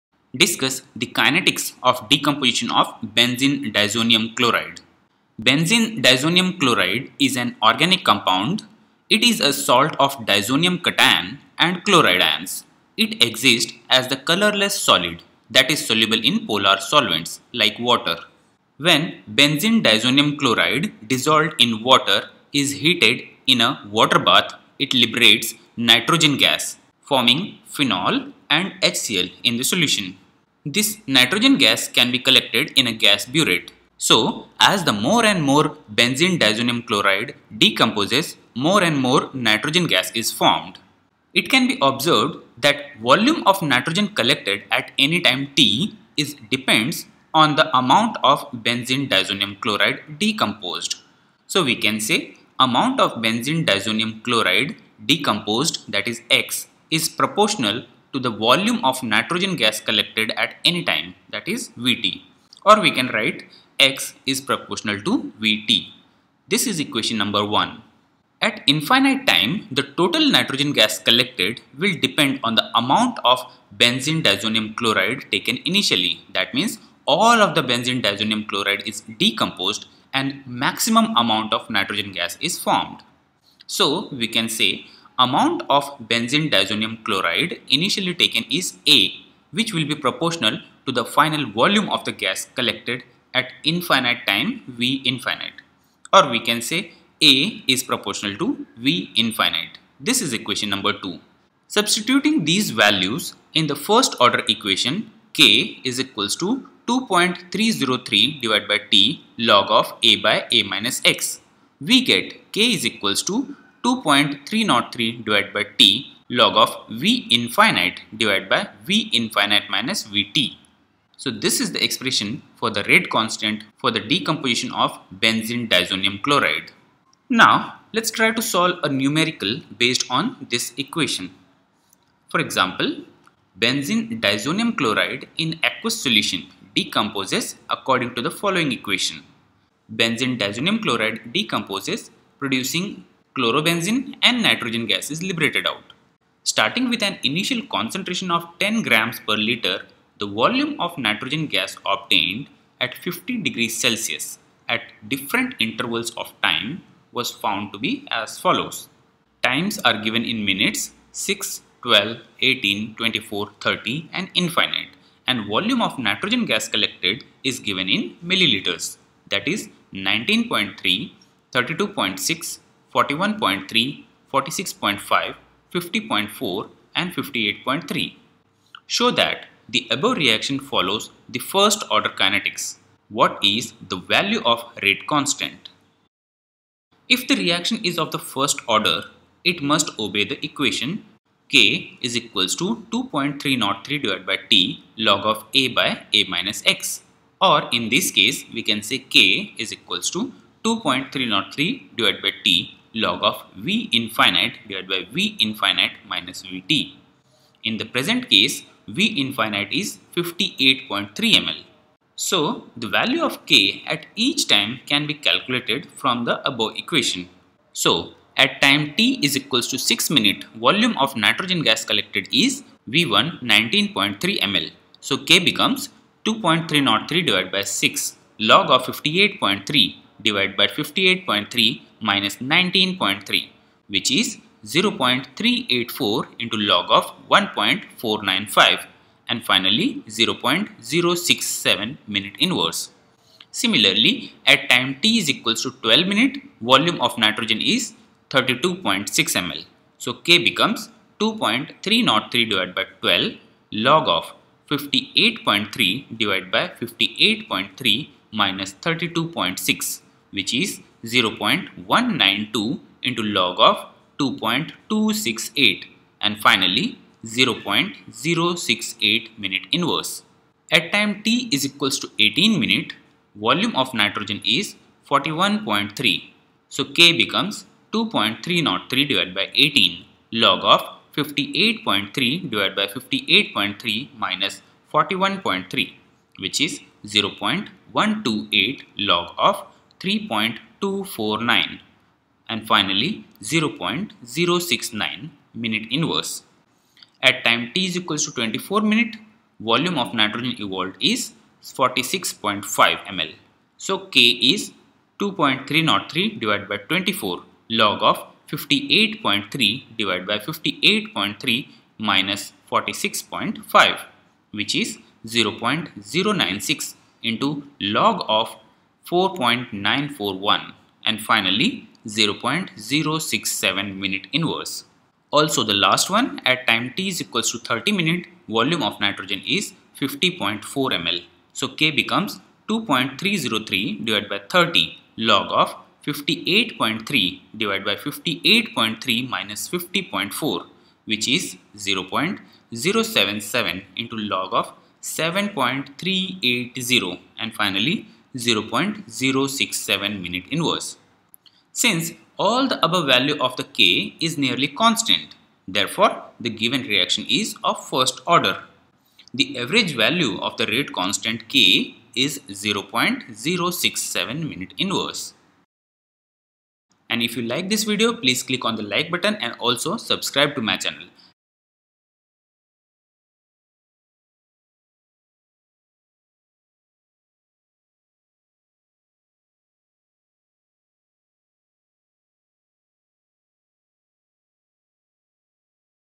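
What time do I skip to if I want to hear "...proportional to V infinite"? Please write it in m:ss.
1:37.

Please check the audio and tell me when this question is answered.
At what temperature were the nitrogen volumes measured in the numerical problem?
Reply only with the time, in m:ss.
2:32.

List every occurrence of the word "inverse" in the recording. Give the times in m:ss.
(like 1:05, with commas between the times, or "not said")
4:55, 5:50, 6:04.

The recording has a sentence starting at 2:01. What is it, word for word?
So this is the expression for the rate constant for the decomposition of benzene diazonium chloride.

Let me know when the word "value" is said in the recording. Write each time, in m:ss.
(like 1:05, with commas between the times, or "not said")
1:42, 3:03, 3:32, 5:53, 5:59.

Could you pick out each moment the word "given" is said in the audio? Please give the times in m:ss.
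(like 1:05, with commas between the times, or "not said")
2:40, 2:47, 5:56.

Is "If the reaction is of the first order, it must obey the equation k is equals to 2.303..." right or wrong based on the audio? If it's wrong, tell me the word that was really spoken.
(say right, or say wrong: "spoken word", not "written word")
right.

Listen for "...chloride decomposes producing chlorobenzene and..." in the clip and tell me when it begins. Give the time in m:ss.
2:20.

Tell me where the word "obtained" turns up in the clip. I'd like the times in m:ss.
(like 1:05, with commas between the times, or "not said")
2:31.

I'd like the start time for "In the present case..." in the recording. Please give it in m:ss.
3:27.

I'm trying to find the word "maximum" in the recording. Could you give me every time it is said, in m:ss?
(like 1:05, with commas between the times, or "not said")
1:20.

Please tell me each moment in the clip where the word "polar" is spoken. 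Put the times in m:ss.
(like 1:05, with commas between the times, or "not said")
0:16.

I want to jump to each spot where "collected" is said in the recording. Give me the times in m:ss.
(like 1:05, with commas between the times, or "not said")
0:32, 0:44, 0:59, 1:10, 1:32, 2:46, 3:41.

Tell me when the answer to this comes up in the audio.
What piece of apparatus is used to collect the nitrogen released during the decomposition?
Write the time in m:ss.
0:32.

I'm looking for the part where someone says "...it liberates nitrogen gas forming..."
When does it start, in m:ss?
0:24.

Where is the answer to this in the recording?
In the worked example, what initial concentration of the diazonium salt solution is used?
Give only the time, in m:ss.
2:28.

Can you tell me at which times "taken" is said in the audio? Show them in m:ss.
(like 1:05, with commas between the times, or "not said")
1:15, 1:28.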